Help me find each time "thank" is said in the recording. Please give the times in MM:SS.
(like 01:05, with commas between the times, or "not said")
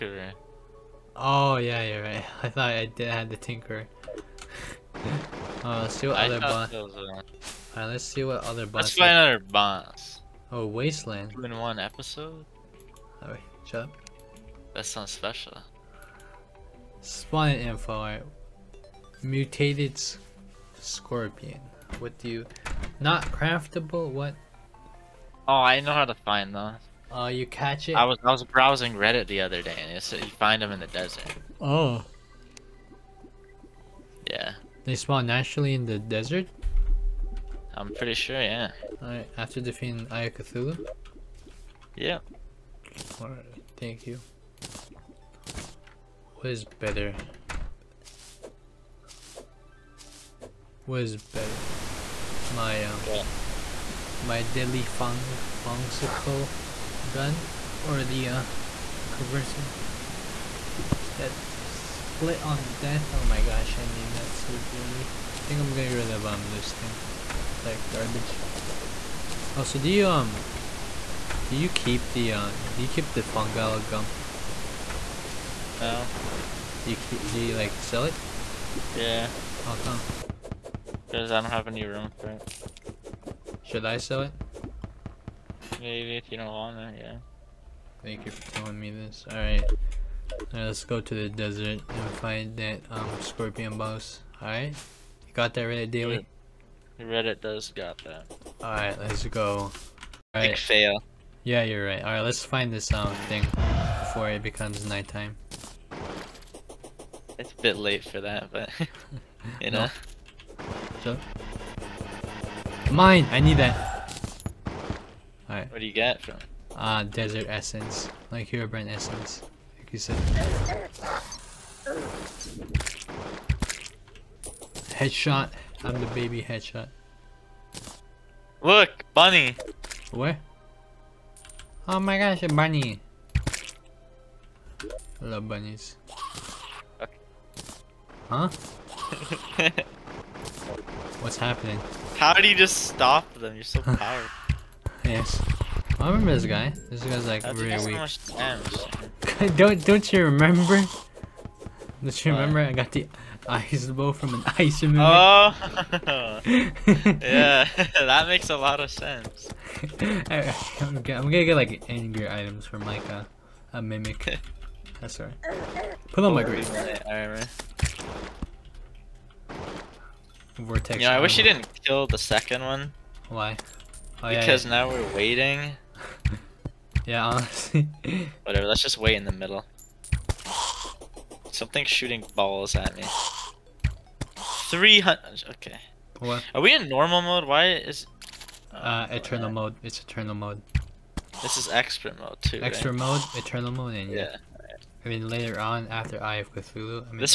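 00:43, 01:28.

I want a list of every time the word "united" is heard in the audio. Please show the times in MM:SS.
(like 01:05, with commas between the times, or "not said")
not said.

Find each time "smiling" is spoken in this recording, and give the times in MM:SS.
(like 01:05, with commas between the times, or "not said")
not said.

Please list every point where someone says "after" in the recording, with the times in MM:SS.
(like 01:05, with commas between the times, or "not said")
00:39, 03:15.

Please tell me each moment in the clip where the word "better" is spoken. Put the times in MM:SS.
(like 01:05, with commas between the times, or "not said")
00:46, 00:51.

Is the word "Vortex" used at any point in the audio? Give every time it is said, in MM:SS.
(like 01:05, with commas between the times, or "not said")
02:50.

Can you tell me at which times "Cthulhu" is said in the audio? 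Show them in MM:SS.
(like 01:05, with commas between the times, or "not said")
00:40, 03:16.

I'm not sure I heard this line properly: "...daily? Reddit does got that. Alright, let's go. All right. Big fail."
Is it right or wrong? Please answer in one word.
right.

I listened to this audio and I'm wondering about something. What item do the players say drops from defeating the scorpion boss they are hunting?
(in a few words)
Desert essence.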